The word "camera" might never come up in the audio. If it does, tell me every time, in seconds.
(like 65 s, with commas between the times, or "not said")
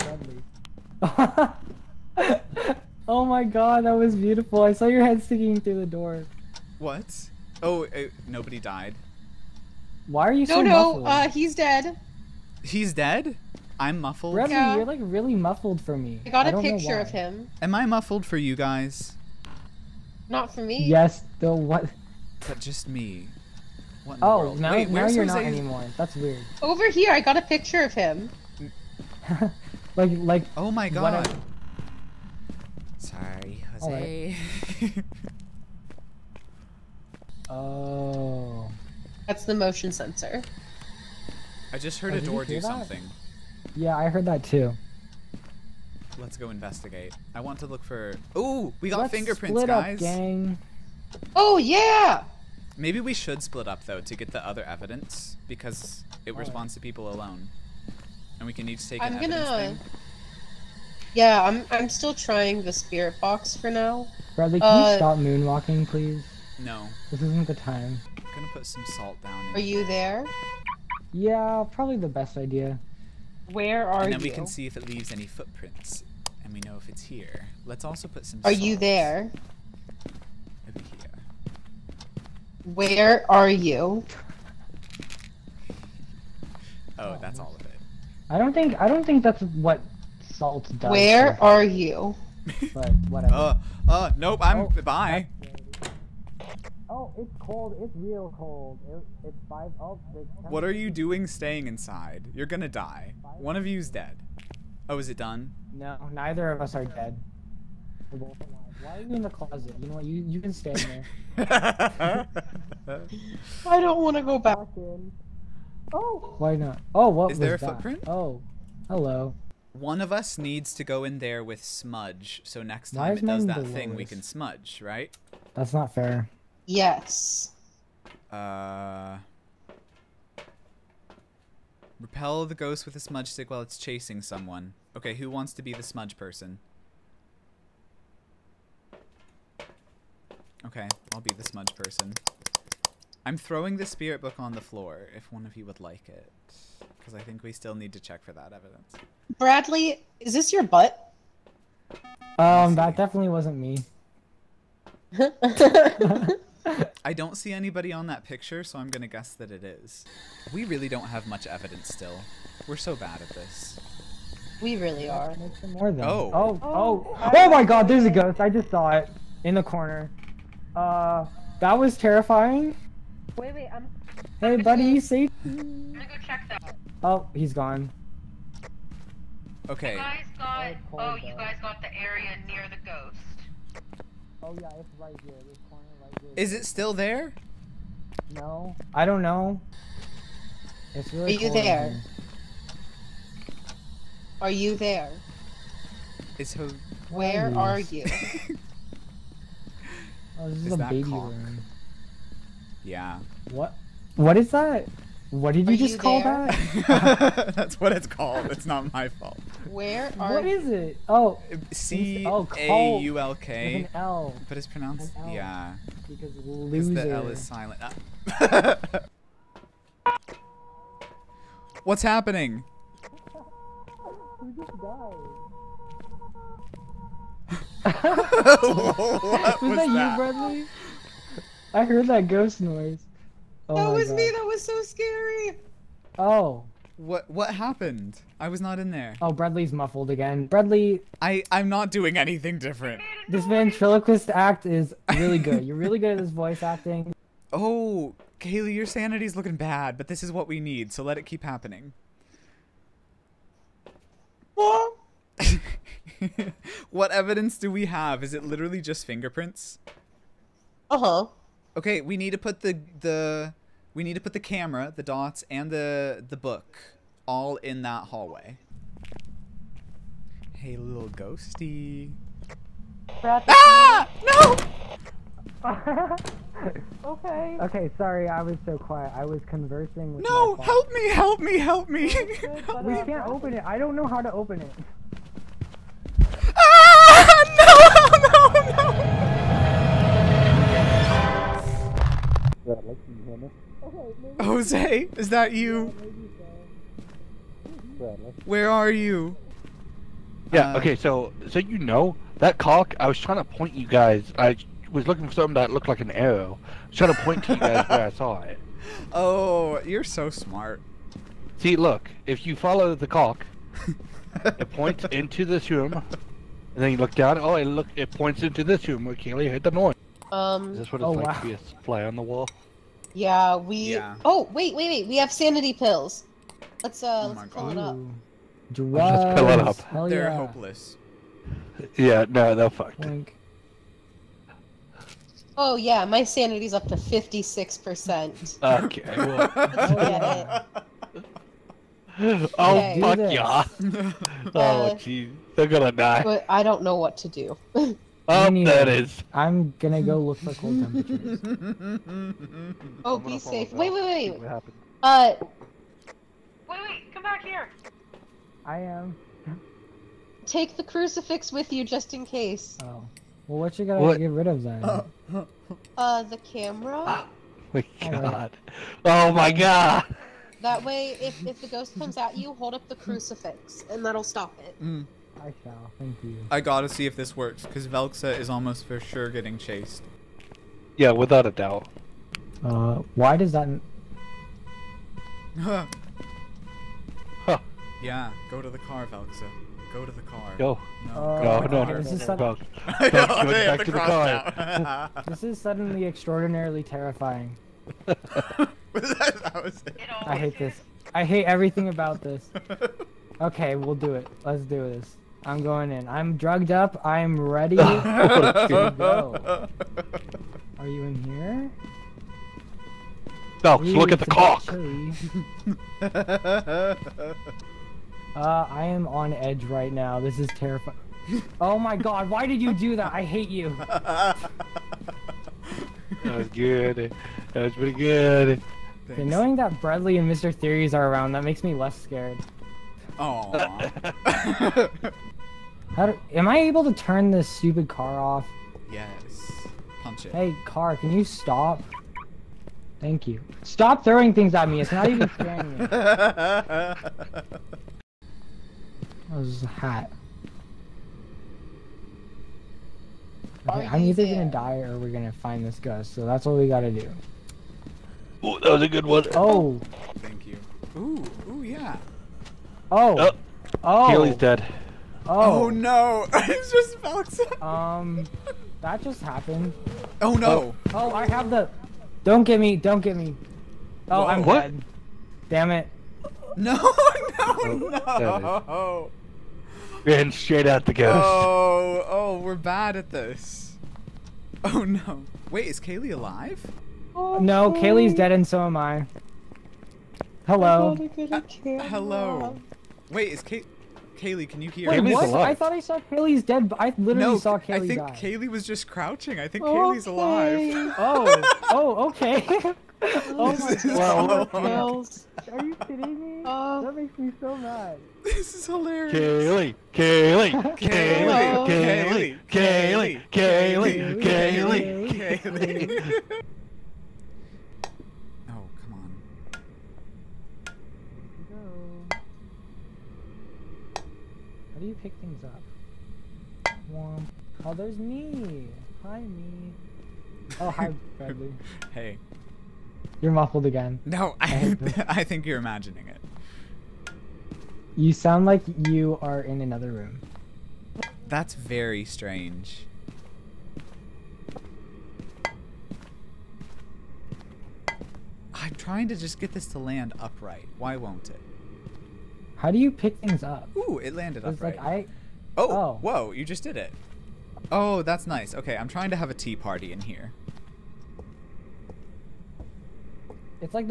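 264 s, 366 s.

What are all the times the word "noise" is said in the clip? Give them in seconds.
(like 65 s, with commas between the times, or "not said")
232 s, 319 s.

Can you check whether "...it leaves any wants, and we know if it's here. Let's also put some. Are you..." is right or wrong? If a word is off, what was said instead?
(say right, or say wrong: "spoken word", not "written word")
wrong: "footprints", not "wants".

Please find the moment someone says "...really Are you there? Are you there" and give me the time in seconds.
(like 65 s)
191 s.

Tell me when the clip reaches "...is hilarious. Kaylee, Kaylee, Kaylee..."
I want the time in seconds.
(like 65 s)
508 s.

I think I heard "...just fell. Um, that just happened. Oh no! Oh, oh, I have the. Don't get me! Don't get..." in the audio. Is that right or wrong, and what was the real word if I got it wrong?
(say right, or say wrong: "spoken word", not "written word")
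right.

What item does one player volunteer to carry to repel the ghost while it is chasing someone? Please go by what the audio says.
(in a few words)
Smudge stick.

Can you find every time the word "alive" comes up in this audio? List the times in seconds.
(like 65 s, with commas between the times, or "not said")
486 s, 500 s.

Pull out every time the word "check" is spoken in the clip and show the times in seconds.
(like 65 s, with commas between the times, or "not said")
148 s, 176 s.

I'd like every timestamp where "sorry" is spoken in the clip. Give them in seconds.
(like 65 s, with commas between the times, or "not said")
32 s, 277 s.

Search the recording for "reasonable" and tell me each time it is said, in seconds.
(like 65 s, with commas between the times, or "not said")
not said.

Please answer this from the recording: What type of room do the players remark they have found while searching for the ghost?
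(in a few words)
Baby room.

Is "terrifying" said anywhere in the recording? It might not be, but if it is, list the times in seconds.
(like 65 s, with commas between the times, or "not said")
171 s, 396 s, 420 s.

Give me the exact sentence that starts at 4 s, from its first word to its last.
I saw your head sticking through the door.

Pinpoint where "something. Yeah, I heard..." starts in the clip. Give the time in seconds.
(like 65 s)
42 s.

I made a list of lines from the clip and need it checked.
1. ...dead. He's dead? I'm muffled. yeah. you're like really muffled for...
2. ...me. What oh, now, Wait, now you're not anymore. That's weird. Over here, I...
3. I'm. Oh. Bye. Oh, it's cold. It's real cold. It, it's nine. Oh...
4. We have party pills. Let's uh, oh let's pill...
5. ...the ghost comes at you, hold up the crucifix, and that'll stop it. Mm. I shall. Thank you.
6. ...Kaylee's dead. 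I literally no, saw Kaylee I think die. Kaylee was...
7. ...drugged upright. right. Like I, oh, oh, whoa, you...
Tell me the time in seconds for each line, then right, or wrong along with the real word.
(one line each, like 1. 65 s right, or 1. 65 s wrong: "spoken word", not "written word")
1. 11 s right
2. 22 s right
3. 94 s wrong: "five", not "nine"
4. 325 s wrong: "sanity", not "party"
5. 371 s right
6. 496 s right
7. 554 s wrong: "landed", not "drugged".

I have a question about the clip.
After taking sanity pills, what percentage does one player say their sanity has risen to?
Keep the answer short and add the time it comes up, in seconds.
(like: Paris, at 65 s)
56 percent, at 336 s.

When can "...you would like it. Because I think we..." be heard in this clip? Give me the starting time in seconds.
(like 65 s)
145 s.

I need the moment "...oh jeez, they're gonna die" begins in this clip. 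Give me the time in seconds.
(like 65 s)
344 s.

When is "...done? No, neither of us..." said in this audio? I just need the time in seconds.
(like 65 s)
105 s.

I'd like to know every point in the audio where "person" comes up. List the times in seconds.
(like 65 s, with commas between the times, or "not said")
136 s, 141 s.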